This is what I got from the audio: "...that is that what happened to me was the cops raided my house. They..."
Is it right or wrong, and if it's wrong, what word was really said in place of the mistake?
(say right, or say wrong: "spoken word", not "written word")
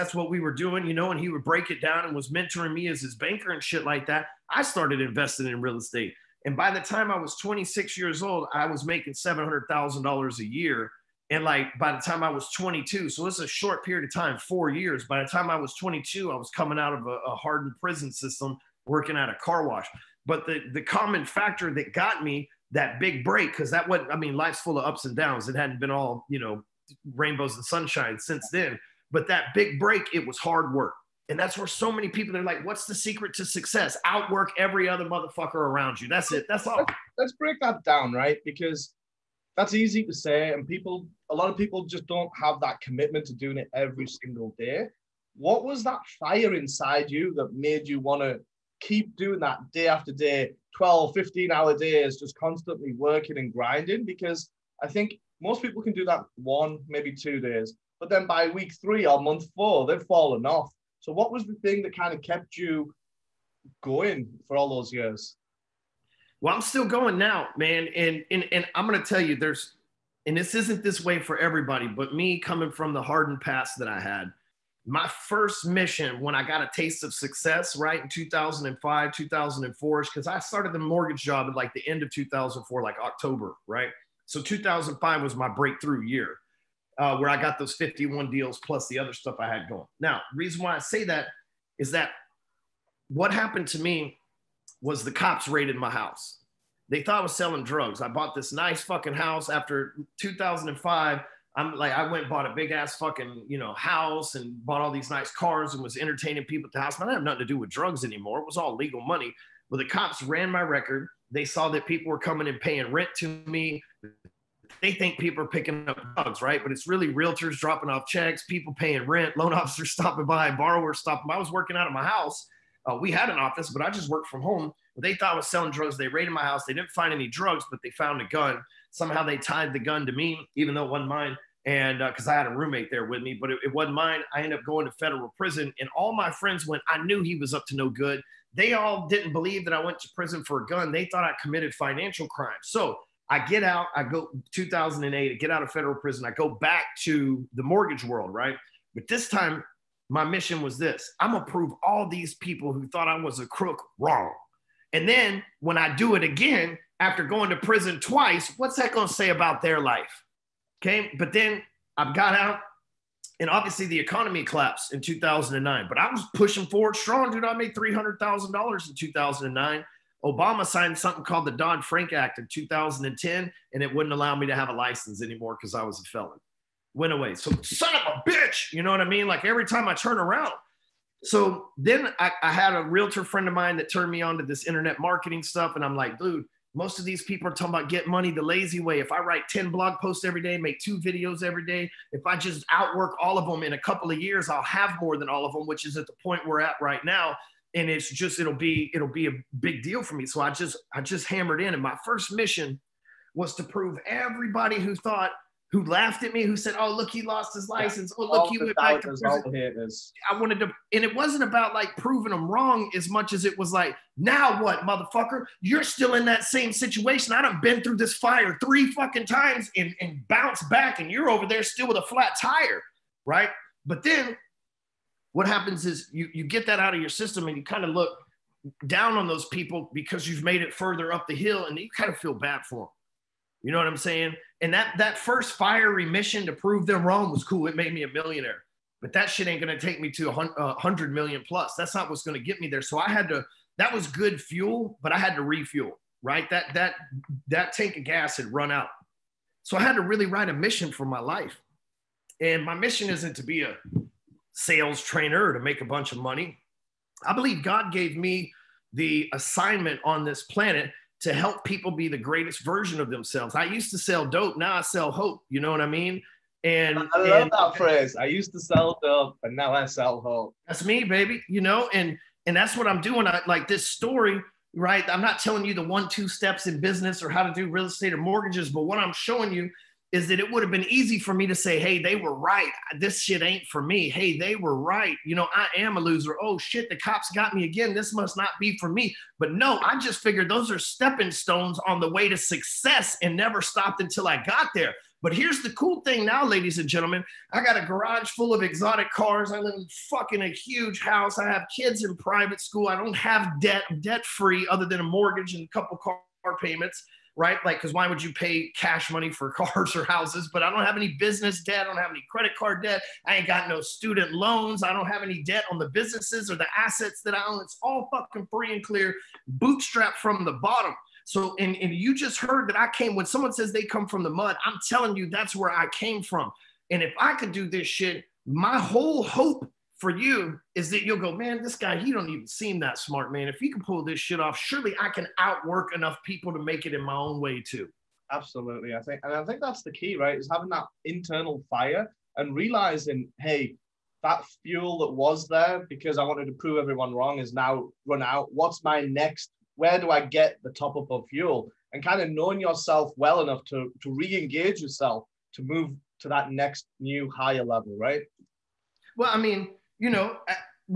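right.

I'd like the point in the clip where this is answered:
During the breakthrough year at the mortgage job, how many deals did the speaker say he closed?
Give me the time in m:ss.
1:27.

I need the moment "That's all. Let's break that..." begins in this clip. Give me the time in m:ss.
0:36.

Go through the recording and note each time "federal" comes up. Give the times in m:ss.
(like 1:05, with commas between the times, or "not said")
2:14, 2:25.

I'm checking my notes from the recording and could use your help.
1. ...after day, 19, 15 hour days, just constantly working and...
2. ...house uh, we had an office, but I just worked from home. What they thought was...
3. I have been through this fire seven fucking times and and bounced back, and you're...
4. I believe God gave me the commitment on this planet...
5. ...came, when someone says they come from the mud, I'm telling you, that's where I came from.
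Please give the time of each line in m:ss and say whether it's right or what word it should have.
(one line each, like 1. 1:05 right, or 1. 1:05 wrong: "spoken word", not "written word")
1. 0:49 wrong: "12", not "19"
2. 2:02 right
3. 3:37 wrong: "three", not "seven"
4. 4:17 wrong: "assignment", not "commitment"
5. 5:22 right.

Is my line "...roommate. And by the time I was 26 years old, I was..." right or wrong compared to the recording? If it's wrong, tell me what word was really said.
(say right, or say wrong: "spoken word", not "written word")
wrong: "estate", not "roommate".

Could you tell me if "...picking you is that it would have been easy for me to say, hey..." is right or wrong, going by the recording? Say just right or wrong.
wrong.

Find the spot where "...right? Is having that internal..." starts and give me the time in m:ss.
5:40.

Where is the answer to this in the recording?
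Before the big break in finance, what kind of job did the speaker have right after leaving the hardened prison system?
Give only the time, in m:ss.
0:18.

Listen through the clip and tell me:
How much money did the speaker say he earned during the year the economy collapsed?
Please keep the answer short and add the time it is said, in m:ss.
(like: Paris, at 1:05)
$300,000, at 2:47.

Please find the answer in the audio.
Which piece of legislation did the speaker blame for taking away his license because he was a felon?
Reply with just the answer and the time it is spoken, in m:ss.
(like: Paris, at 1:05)
Dodd Frank Act, at 2:51.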